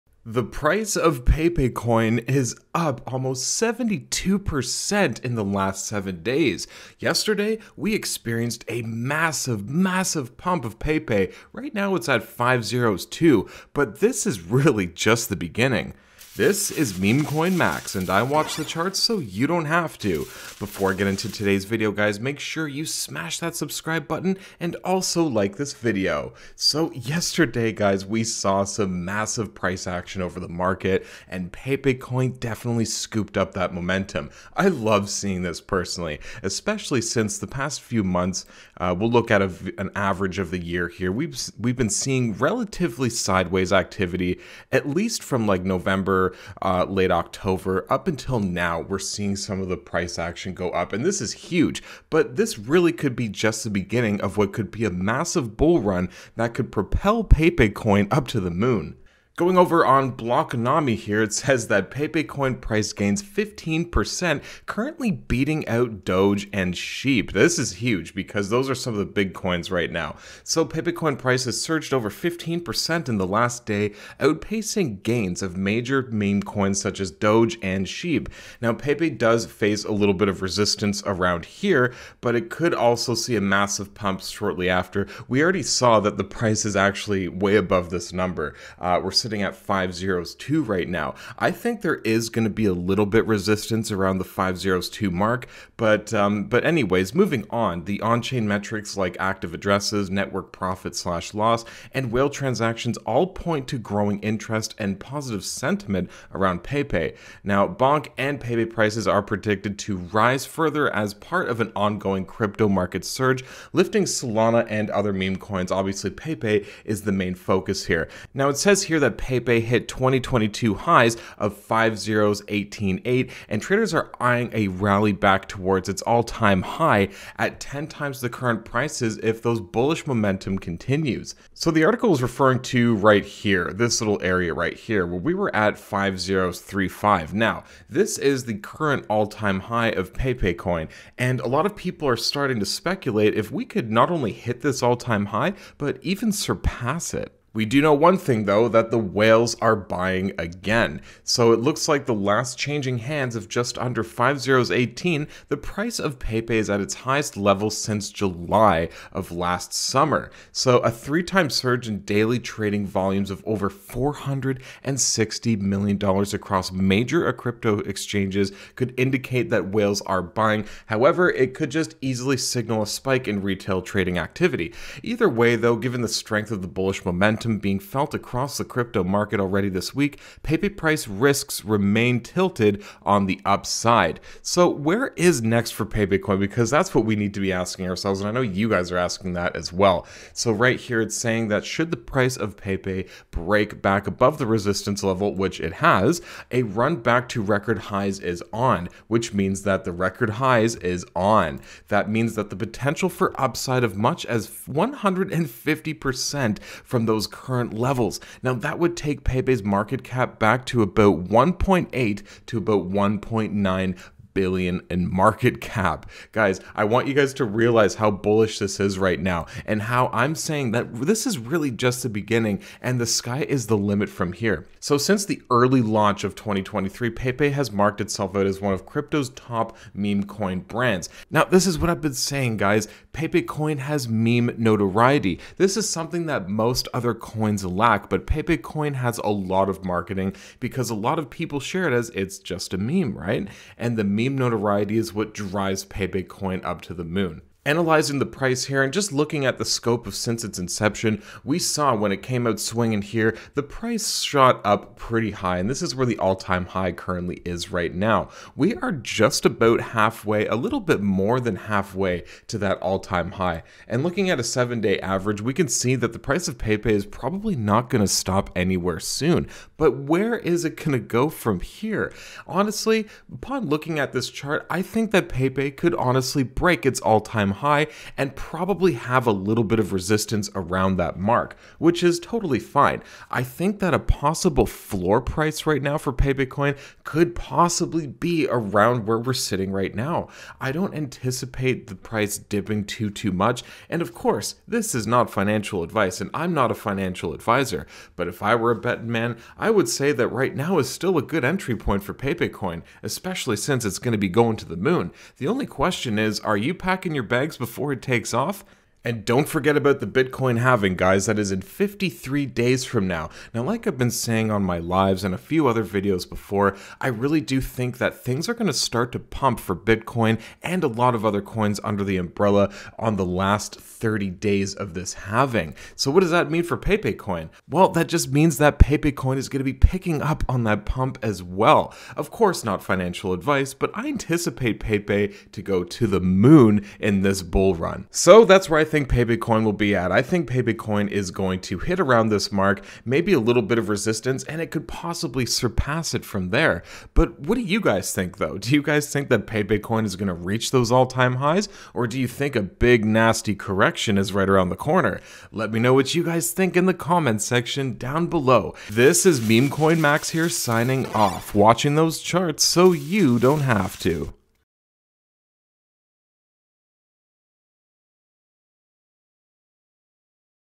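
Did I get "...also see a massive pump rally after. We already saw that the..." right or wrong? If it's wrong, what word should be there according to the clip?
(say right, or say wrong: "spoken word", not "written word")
wrong: "shortly", not "rally".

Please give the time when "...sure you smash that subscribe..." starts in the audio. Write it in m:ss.
0:22.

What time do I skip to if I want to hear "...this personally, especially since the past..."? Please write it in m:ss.
0:35.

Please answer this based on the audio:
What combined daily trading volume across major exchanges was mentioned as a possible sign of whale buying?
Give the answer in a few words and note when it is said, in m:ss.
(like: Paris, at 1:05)
over $460 million, at 2:43.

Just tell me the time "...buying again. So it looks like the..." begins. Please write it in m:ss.
2:29.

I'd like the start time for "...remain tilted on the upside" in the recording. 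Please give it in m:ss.
3:01.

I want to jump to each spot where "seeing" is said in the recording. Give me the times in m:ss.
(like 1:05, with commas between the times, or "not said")
0:35, 0:41, 0:48.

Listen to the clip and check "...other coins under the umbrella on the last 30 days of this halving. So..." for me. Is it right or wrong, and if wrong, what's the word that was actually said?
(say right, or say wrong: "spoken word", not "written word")
right.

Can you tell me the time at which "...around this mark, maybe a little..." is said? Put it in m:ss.
5:41.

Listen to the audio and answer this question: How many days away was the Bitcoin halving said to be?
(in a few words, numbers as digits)
53.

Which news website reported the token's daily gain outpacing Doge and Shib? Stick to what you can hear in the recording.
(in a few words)
Blockonomi.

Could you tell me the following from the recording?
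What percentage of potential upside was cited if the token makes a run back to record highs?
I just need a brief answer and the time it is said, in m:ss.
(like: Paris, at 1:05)
150%, at 3:24.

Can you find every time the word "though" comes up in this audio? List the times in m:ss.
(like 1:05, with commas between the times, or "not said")
2:28, 2:55, 5:48.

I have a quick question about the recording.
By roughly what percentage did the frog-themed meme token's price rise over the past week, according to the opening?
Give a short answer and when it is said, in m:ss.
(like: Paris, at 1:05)
72%, at 0:03.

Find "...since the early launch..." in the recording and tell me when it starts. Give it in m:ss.
3:44.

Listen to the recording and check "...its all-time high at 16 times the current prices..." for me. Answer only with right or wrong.
wrong.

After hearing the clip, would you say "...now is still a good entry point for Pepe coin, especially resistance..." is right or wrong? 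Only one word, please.
wrong.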